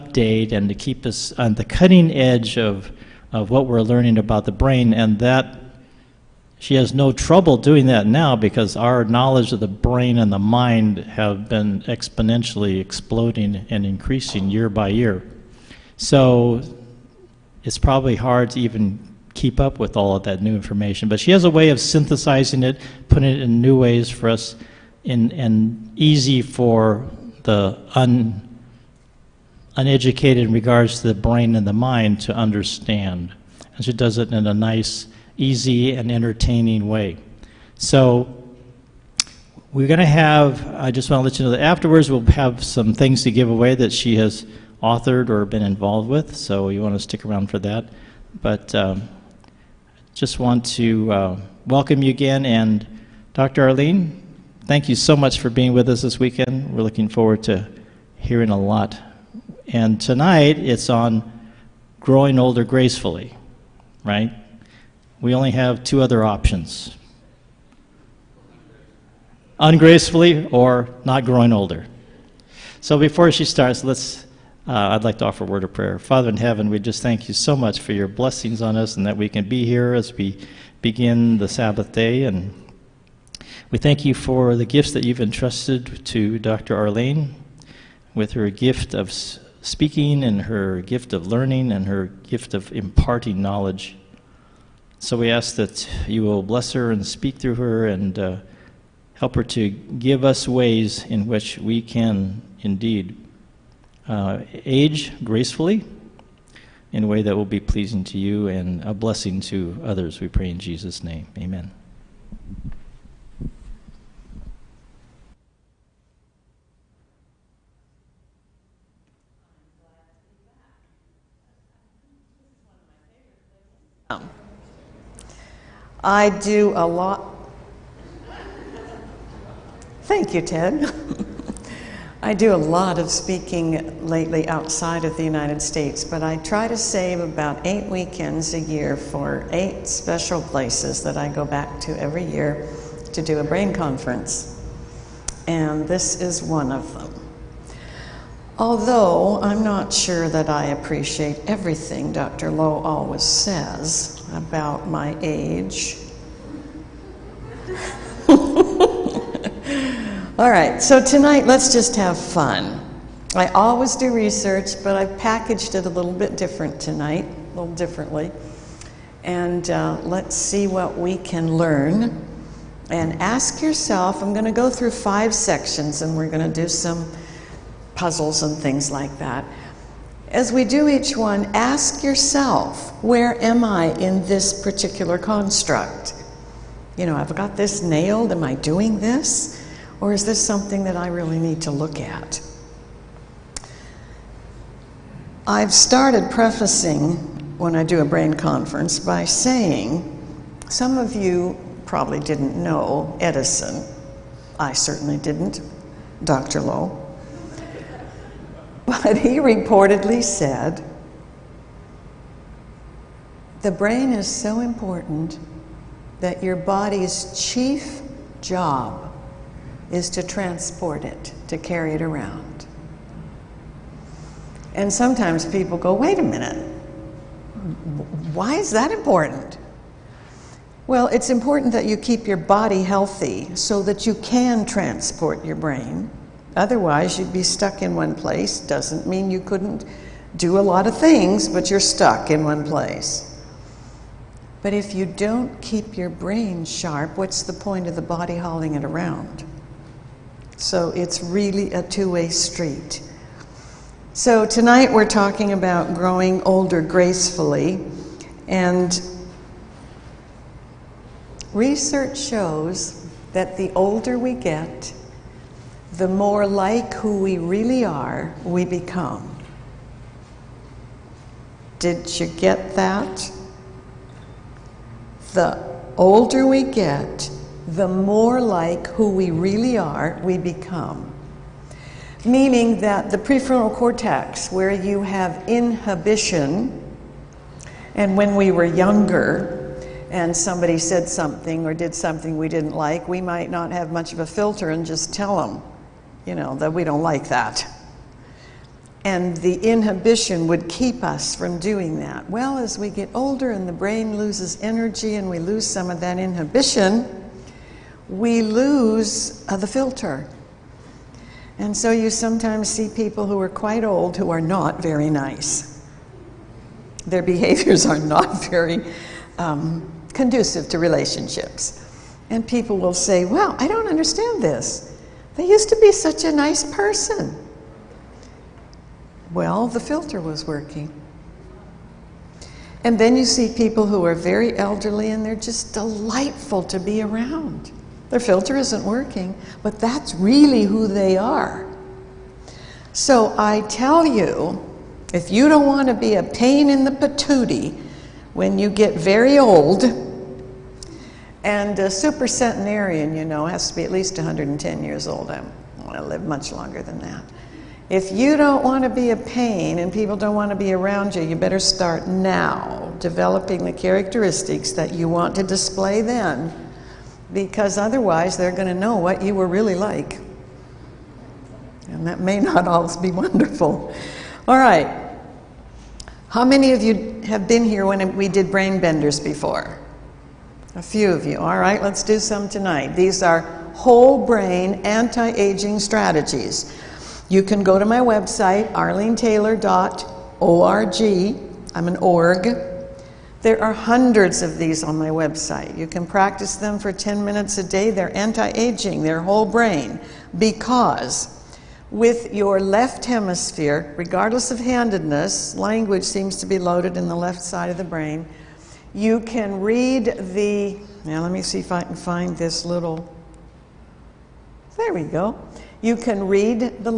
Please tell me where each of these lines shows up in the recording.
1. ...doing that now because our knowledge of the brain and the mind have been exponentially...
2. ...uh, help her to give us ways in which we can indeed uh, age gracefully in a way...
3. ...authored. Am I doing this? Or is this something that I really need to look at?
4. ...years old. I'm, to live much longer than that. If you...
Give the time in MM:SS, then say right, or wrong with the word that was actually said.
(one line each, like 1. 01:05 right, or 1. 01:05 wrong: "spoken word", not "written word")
1. 00:07 right
2. 01:38 right
3. 03:07 wrong: "nailed", not "authored"
4. 05:54 right.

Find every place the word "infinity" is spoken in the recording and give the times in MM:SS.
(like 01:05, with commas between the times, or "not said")
not said.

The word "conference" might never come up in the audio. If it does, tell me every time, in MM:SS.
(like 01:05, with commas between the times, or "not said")
02:23, 03:18.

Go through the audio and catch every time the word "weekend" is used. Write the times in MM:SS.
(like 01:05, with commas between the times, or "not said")
00:56, 02:17.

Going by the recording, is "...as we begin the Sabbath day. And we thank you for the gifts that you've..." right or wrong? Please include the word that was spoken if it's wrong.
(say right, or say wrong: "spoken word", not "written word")
right.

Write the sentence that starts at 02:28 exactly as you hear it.
Although I'm not sure that I appreciate everything Dr.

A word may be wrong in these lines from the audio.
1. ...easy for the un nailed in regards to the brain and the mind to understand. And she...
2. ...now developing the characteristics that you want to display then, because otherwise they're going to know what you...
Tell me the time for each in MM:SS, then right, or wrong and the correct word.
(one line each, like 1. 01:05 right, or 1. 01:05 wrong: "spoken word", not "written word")
1. 00:25 wrong: "uneducated", not "nailed"
2. 06:02 right.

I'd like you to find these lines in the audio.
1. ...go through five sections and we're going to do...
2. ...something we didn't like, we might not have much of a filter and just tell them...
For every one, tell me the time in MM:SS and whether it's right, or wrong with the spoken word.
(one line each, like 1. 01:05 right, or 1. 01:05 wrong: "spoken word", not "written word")
1. 02:54 right
2. 04:51 right.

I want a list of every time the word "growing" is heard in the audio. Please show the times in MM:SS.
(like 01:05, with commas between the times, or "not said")
01:02, 01:11, 04:15.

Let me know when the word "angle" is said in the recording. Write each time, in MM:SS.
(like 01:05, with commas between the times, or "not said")
not said.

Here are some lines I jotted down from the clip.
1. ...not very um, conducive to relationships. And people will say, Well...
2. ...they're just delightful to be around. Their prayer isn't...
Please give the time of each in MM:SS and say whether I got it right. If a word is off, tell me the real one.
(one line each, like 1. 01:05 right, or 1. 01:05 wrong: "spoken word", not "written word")
1. 05:17 right
2. 05:35 wrong: "filter", not "prayer".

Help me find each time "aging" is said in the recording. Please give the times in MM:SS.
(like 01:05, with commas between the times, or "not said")
06:25, 06:38.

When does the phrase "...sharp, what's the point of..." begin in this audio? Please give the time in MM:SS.
04:06.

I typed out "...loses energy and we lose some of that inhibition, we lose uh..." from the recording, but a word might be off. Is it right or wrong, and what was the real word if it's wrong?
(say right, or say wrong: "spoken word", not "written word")
right.